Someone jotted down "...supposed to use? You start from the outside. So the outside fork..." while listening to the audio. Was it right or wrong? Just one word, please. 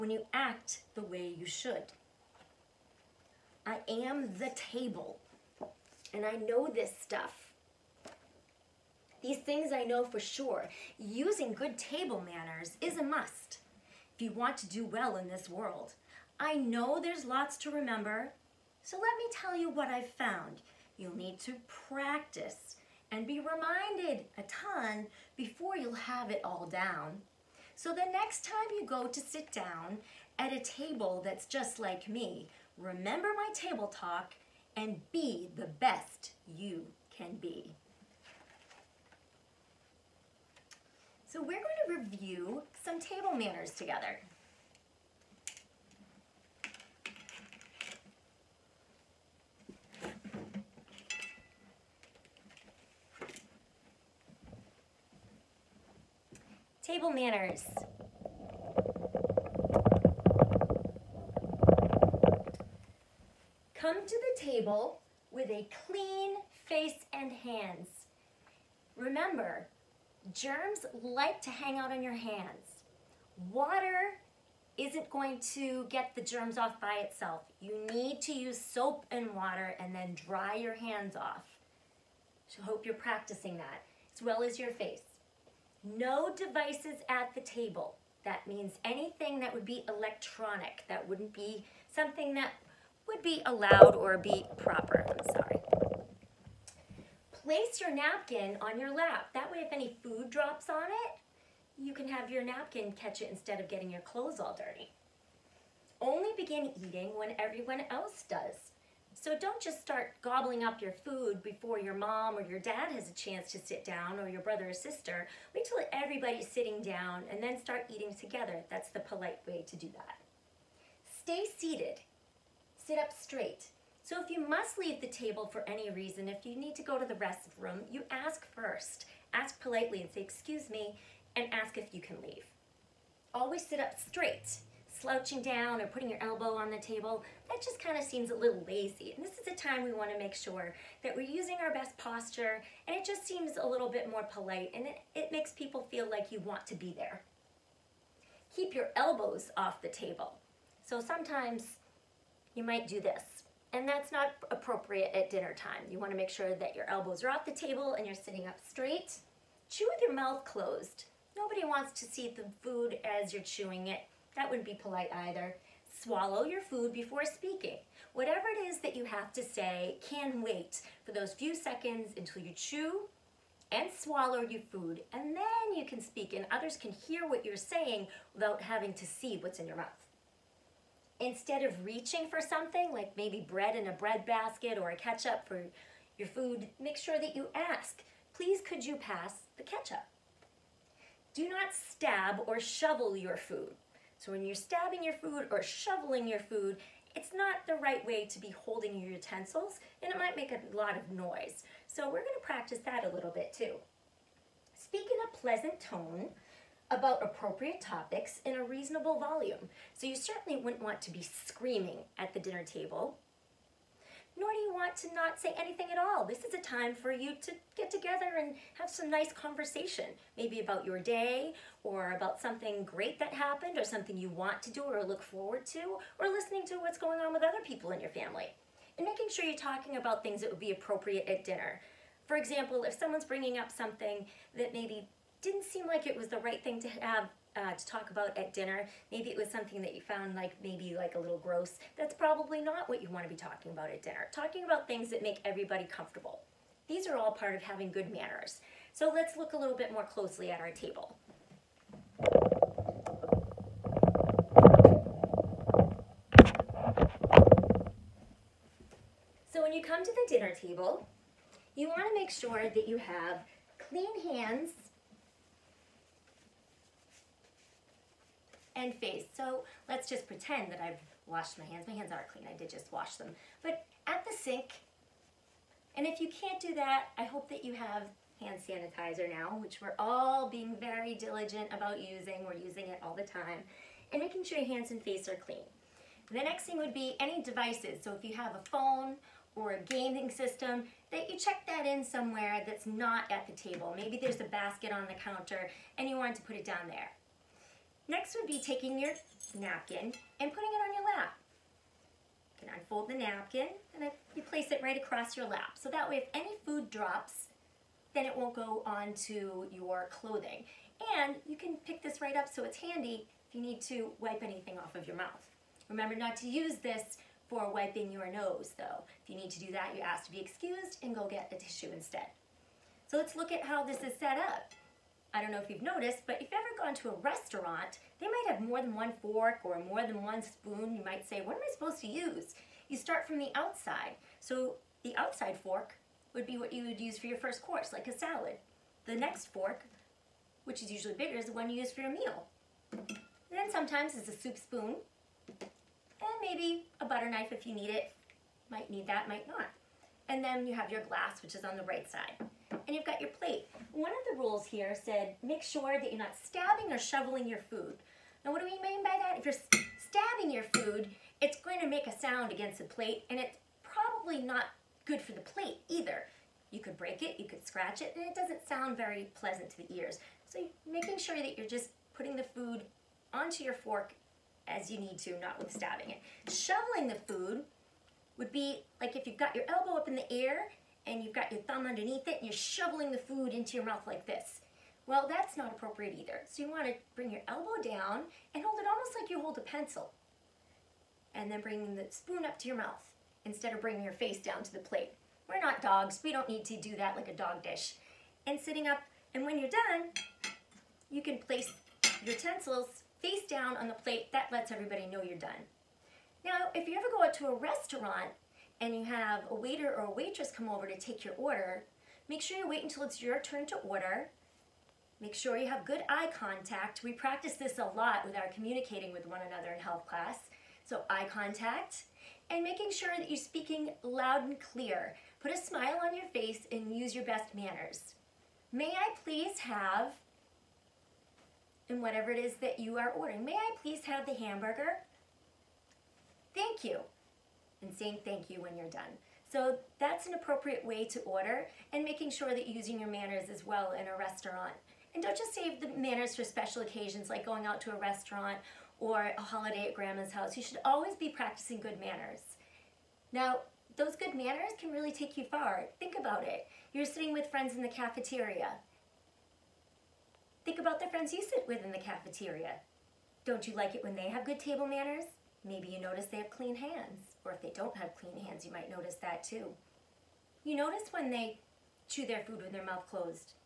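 right.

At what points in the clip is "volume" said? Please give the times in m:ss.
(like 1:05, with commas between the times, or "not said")
3:29.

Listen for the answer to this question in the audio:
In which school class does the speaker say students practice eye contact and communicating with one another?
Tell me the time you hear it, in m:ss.
6:59.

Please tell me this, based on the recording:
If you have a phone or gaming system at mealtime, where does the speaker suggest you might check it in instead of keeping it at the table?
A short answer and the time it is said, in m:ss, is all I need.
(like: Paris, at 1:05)
a basket on the counter, at 4:54.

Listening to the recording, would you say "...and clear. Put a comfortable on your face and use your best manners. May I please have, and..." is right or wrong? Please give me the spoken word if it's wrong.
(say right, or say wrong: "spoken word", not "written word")
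wrong: "smile", not "comfortable".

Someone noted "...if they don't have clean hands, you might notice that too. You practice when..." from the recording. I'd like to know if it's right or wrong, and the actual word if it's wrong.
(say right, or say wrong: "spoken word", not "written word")
wrong: "notice", not "practice".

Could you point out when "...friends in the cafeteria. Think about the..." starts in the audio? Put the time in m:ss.
7:37.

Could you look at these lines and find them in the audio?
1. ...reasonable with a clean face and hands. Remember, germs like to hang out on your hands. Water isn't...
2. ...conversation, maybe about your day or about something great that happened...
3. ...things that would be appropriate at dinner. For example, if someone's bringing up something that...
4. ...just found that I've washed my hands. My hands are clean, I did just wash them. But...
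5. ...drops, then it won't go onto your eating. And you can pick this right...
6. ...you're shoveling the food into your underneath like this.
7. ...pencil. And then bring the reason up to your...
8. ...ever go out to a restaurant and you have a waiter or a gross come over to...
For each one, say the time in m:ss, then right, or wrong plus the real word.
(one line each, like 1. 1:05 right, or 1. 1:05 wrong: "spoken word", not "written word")
1. 1:04 wrong: "table", not "reasonable"
2. 3:39 right
3. 3:50 right
4. 4:30 wrong: "pretend", not "found"
5. 5:06 wrong: "clothing", not "eating"
6. 6:22 wrong: "mouth", not "underneath"
7. 6:29 wrong: "spoon", not "reason"
8. 6:46 wrong: "waitress", not "gross".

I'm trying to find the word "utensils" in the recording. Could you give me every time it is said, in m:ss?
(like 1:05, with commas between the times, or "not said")
3:19, 6:42.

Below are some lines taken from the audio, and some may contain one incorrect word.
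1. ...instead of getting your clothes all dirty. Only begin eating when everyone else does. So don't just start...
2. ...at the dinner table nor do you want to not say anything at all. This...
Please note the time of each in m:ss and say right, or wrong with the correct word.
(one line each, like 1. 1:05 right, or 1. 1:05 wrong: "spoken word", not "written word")
1. 1:43 right
2. 3:32 right.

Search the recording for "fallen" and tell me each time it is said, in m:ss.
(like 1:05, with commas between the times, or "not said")
not said.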